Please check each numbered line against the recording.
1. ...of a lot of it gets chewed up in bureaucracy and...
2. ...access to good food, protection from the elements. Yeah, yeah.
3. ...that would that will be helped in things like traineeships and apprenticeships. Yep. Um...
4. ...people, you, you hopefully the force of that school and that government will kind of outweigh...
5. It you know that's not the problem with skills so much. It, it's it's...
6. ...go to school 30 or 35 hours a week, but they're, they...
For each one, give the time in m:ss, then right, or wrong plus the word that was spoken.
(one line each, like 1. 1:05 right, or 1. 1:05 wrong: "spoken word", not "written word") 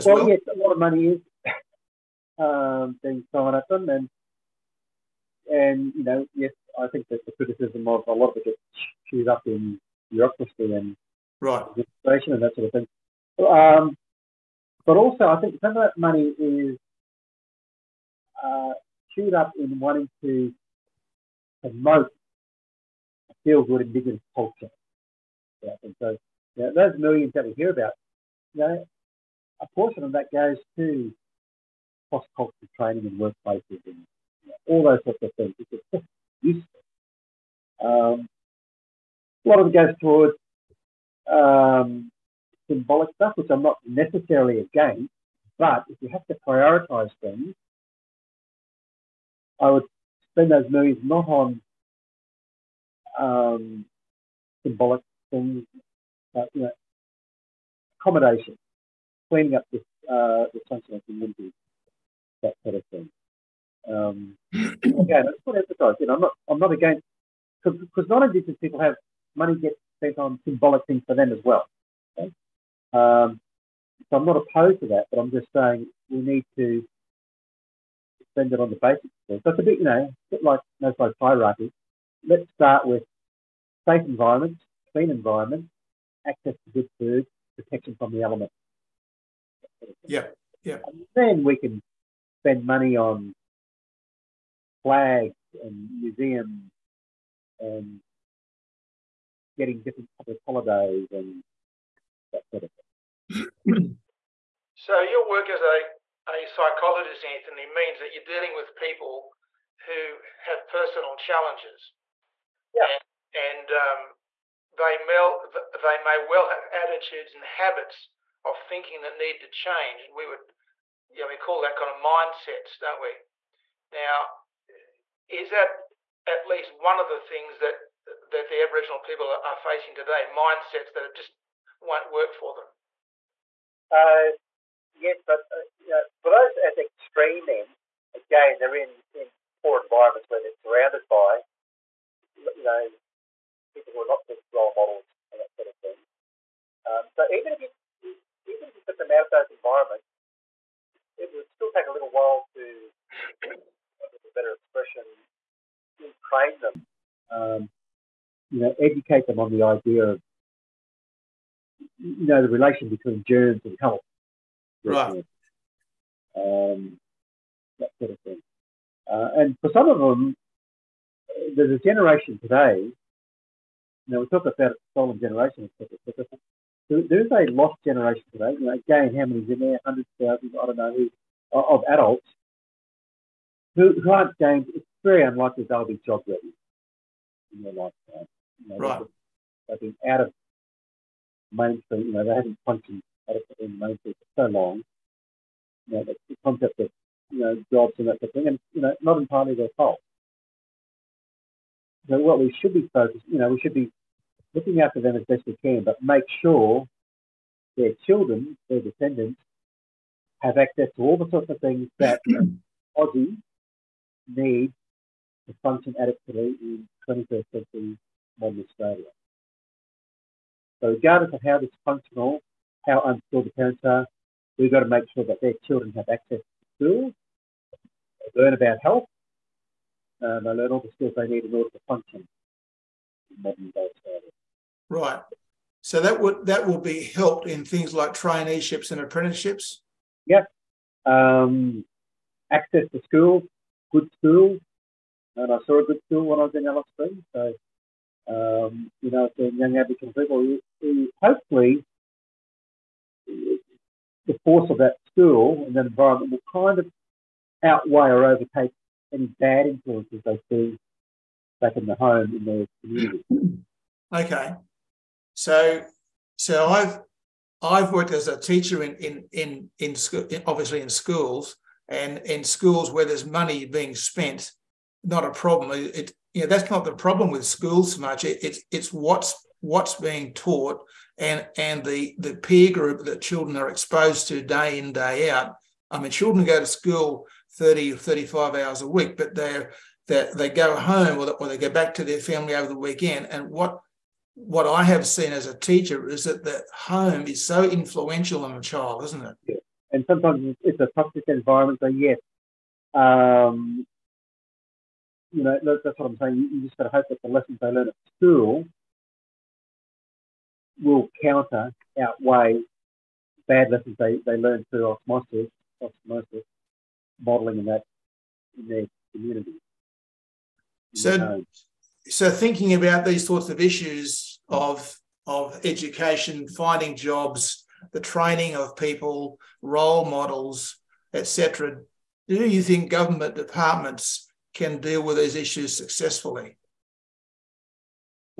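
1. 0:07 right
2. 1:26 right
3. 3:56 right
4. 4:10 wrong: "environment", not "government"
5. 4:35 wrong: "schools", not "skills"
6. 4:46 right.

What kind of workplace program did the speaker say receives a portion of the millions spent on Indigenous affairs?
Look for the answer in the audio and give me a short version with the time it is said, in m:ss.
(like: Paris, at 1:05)
cross-cultural training, at 0:32.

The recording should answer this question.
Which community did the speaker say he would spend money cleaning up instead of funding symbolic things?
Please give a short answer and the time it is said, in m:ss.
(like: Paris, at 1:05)
the sunshine community, at 1:00.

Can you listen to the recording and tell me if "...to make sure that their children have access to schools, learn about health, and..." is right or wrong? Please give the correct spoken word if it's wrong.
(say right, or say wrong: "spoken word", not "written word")
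right.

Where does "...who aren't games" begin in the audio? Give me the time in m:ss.
3:04.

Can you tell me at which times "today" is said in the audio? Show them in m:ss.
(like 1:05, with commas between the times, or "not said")
2:09, 2:52, 2:58.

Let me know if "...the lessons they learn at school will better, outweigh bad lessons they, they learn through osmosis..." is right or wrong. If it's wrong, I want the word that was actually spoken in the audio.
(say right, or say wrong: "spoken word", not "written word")
wrong: "counter", not "better".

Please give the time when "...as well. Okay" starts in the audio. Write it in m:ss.
1:11.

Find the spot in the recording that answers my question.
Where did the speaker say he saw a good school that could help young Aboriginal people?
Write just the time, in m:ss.
4:06.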